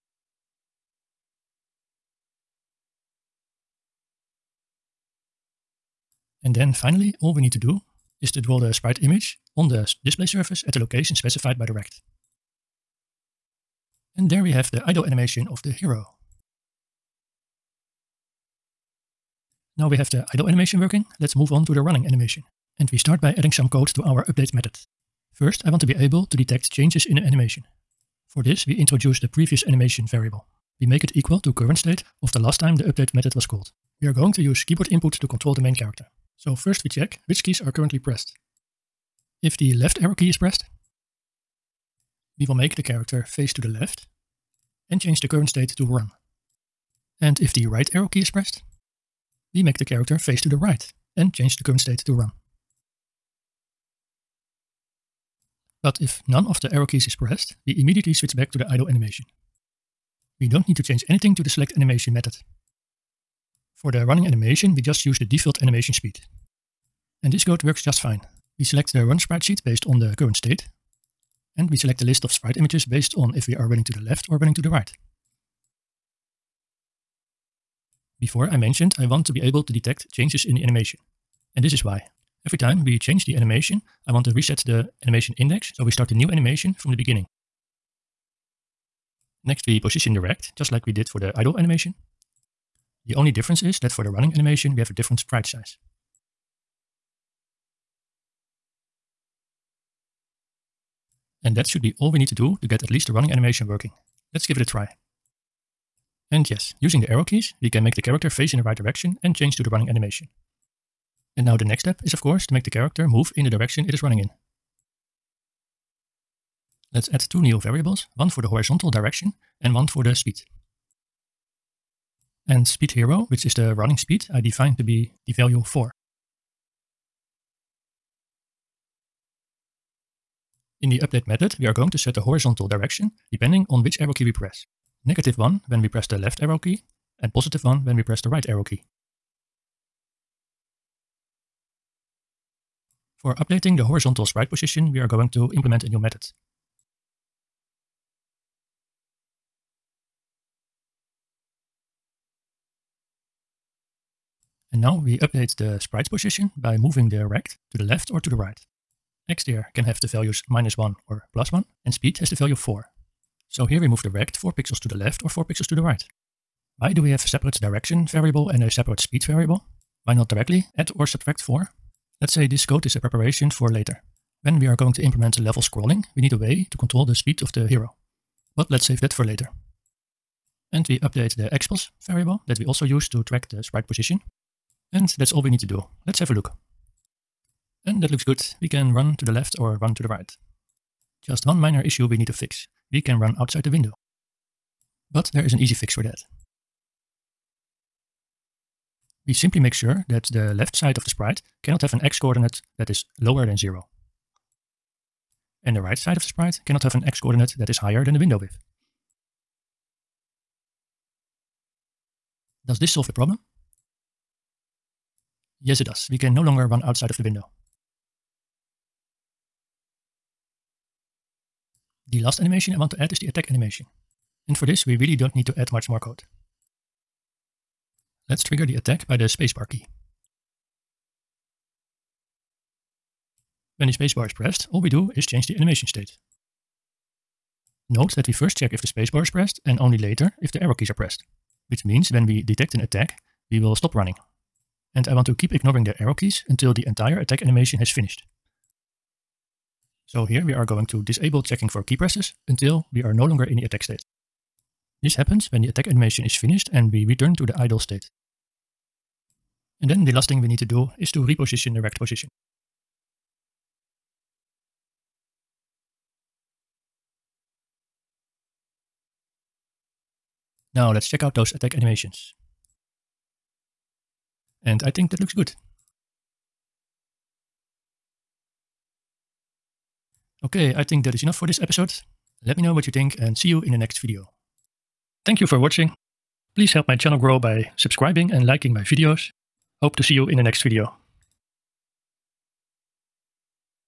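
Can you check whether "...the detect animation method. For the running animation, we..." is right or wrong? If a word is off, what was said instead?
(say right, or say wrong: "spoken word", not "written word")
wrong: "select", not "detect".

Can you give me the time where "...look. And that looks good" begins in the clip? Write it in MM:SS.
03:06.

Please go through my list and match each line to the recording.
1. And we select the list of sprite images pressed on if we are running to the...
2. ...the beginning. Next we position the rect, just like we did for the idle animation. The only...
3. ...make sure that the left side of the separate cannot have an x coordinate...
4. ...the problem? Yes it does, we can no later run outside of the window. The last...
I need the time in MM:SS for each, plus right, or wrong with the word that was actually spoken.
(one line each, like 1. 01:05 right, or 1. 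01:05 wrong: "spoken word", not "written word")
1. 01:11 wrong: "based", not "pressed"
2. 01:26 right
3. 03:19 wrong: "sprite", not "separate"
4. 03:33 wrong: "longer", not "later".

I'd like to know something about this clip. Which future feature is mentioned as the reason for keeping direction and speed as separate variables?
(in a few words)
Level scrolling.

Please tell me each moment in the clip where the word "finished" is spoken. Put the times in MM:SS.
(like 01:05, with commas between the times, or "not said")
04:07, 04:16.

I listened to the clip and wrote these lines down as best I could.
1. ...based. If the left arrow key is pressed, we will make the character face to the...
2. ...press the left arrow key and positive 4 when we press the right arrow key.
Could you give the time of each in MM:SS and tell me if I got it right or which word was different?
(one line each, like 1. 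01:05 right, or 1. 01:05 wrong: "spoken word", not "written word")
1. 00:37 wrong: "pressed", not "based"
2. 02:15 wrong: "1", not "4".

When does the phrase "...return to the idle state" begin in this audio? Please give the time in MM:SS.
04:17.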